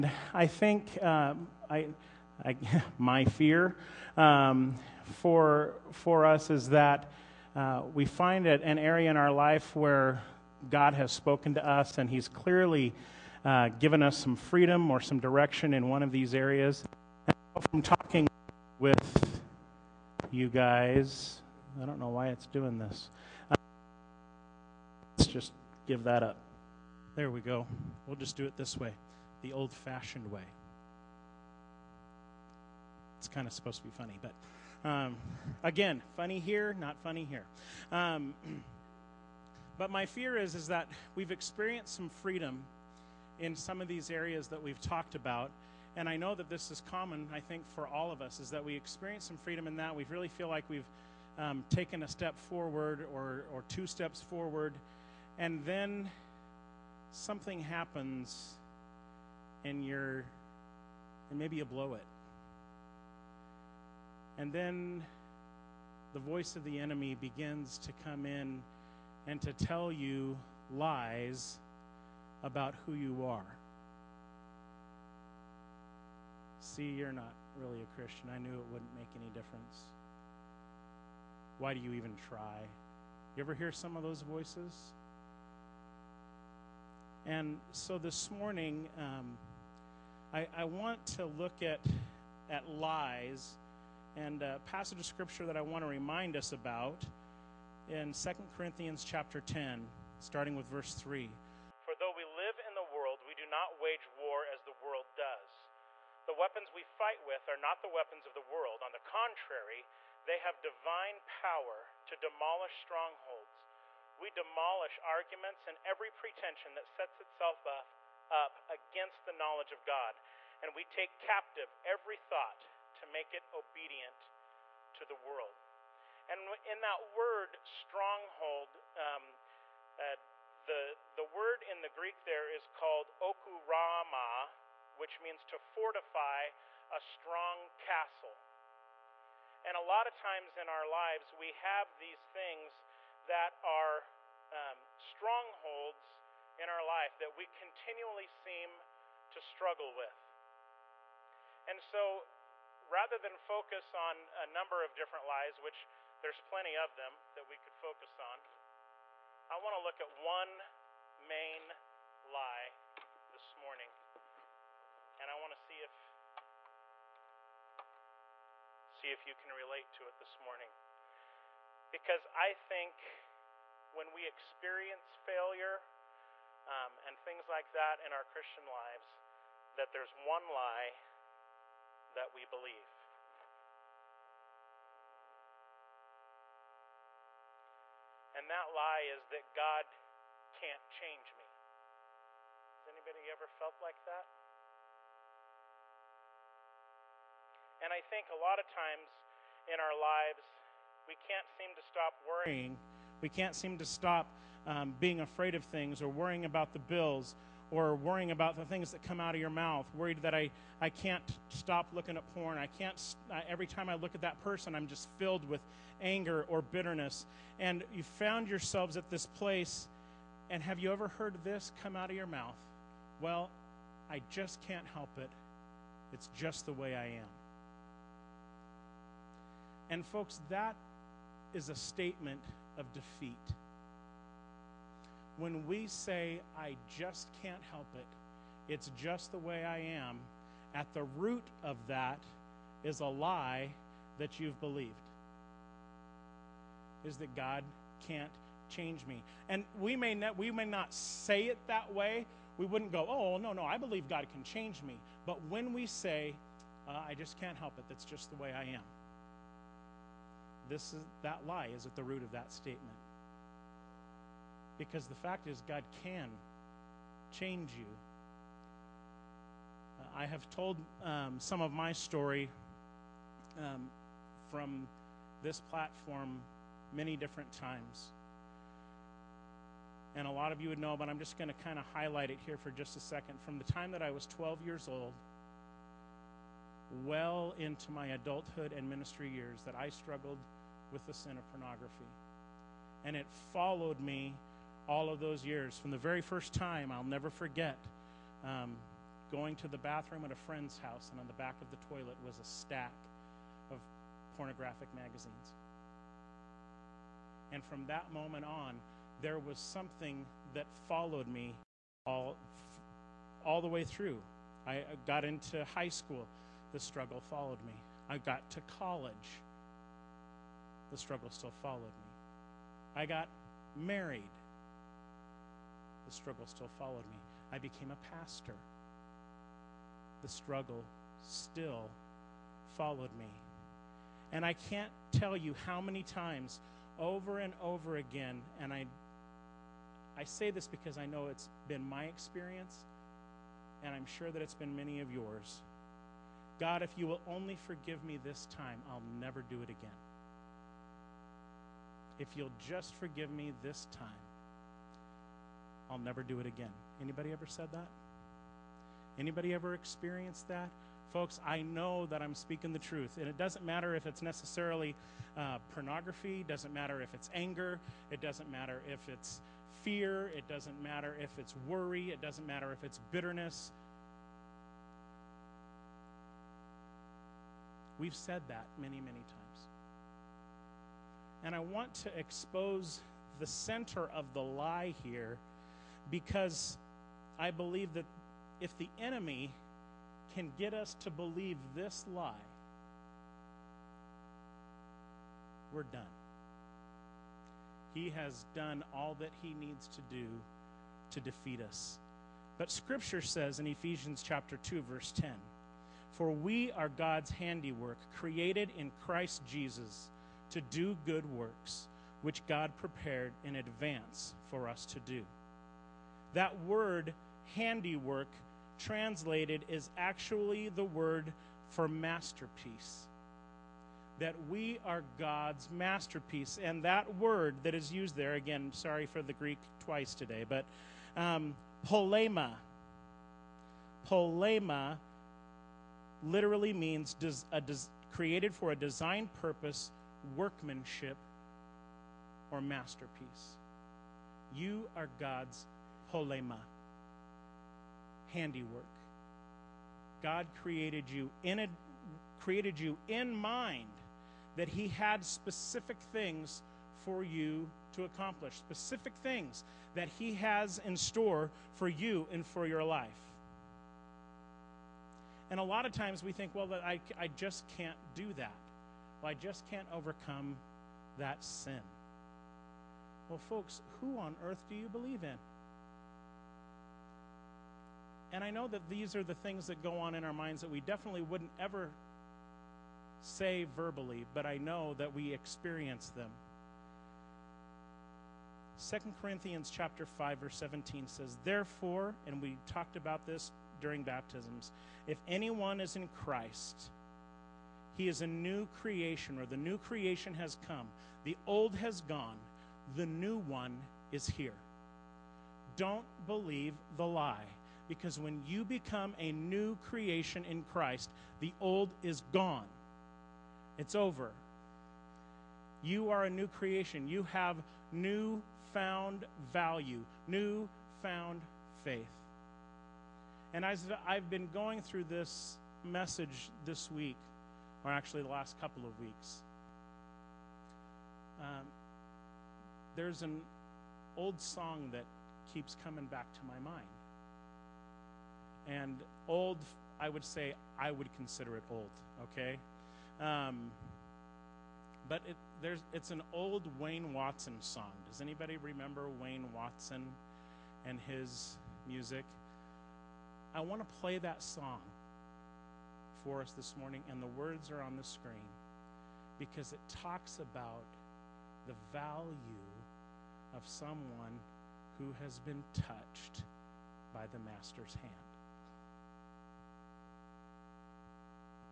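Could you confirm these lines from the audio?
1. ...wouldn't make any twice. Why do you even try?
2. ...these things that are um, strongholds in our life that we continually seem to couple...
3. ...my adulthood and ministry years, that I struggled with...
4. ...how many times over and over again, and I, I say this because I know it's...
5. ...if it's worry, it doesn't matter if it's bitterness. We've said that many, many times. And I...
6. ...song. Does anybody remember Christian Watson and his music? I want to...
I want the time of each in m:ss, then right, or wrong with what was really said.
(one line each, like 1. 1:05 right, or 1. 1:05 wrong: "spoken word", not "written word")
1. 1:18 wrong: "difference", not "twice"
2. 2:21 wrong: "struggle", not "couple"
3. 4:47 right
4. 5:35 right
5. 6:11 right
6. 9:07 wrong: "Wayne", not "Christian".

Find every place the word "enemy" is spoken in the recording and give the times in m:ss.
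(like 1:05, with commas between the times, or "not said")
1:06, 6:29.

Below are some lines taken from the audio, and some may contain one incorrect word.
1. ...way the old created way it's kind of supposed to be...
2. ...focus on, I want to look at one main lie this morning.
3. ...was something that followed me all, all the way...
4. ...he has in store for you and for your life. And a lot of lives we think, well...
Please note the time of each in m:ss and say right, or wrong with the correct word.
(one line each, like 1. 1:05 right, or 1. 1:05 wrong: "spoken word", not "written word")
1. 0:28 wrong: "fashioned", not "created"
2. 2:37 right
3. 5:09 right
4. 7:40 wrong: "times", not "lives".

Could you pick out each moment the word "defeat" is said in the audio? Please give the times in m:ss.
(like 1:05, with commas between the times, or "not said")
3:52, 6:41.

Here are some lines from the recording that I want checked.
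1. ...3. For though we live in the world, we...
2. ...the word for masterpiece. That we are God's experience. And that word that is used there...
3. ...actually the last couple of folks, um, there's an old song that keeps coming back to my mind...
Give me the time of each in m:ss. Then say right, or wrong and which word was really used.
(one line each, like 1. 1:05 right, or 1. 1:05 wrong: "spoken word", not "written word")
1. 1:40 right
2. 7:00 wrong: "masterpiece", not "experience"
3. 8:47 wrong: "weeks", not "folks".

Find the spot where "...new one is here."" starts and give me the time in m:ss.
8:23.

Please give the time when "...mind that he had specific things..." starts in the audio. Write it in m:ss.
7:33.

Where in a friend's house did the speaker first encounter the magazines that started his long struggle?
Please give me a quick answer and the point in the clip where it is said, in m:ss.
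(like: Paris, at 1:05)
the bathroom, at 4:59.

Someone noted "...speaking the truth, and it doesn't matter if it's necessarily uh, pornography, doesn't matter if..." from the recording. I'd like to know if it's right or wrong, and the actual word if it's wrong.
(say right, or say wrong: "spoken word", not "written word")
right.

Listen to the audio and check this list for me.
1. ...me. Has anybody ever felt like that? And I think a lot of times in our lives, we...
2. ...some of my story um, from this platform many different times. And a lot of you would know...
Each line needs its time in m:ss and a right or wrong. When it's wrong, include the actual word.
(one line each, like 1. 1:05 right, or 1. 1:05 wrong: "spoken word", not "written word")
1. 3:11 right
2. 4:31 right.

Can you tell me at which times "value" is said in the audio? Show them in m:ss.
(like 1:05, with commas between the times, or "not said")
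8:39, 9:21.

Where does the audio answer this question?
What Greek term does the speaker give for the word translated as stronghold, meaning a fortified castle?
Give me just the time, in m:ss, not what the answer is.
2:13.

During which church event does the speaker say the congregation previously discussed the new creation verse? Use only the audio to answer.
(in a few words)
baptisms.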